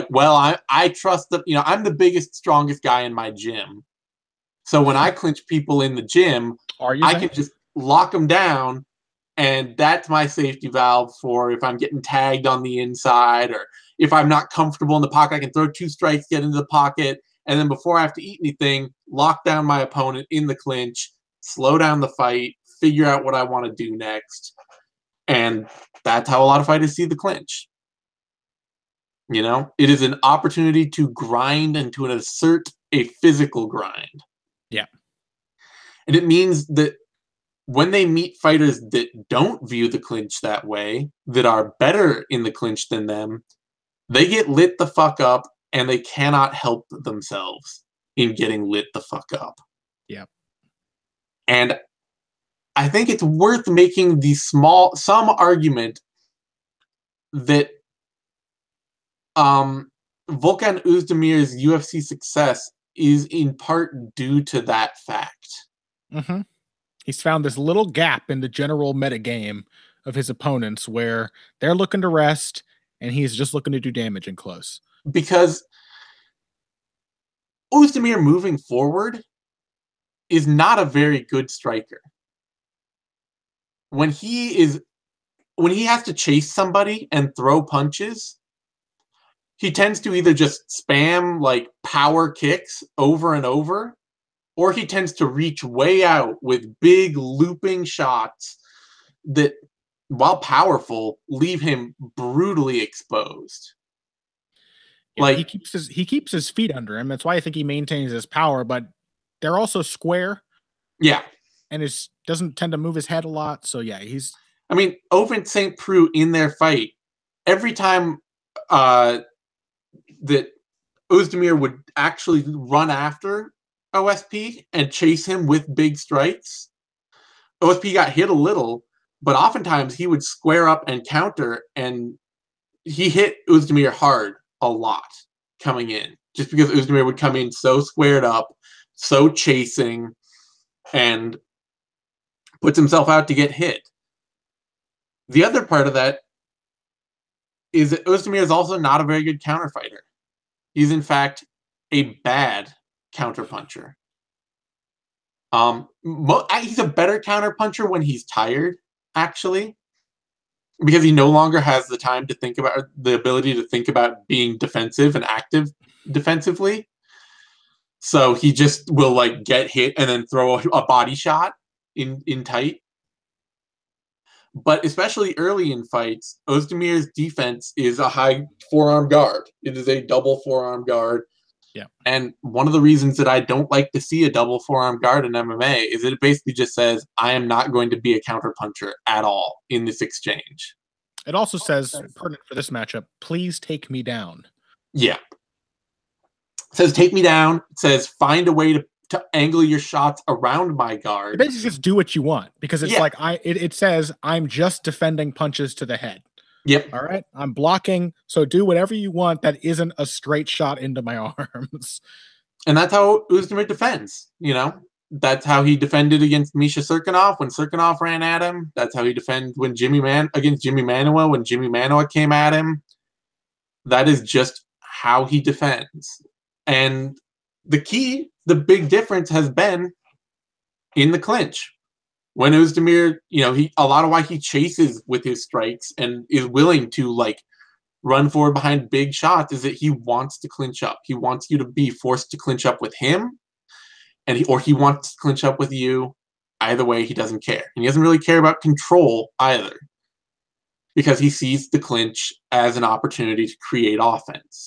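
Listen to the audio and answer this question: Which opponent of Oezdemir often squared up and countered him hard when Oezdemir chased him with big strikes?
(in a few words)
Ovince St. Preux.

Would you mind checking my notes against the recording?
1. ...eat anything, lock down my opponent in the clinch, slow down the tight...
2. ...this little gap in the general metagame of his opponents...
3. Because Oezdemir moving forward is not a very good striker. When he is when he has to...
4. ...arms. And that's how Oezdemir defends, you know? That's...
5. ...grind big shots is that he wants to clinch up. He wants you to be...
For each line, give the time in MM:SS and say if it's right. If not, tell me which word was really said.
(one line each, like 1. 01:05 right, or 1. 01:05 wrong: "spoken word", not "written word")
1. 00:18 wrong: "fight", not "tight"
2. 01:07 right
3. 01:15 right
4. 03:31 right
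5. 03:58 wrong: "behind", not "grind".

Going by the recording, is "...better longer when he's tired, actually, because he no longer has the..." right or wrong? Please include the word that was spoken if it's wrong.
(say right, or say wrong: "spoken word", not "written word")
wrong: "counterpuncher", not "longer".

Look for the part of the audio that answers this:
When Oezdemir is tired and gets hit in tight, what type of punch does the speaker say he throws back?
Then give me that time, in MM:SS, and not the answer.
02:50.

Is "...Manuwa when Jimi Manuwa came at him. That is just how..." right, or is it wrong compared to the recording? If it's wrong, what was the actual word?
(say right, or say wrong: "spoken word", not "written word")
right.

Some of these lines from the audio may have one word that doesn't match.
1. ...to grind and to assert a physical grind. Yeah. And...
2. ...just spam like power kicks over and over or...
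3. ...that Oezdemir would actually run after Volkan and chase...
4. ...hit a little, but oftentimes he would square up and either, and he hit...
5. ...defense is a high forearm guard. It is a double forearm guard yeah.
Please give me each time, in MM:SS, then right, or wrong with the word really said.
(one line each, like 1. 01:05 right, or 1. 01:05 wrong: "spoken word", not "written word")
1. 00:30 right
2. 01:30 right
3. 02:00 wrong: "OSP", not "Volkan"
4. 02:08 wrong: "counter", not "either"
5. 02:57 right.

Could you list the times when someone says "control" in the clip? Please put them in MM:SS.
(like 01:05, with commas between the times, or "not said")
04:08.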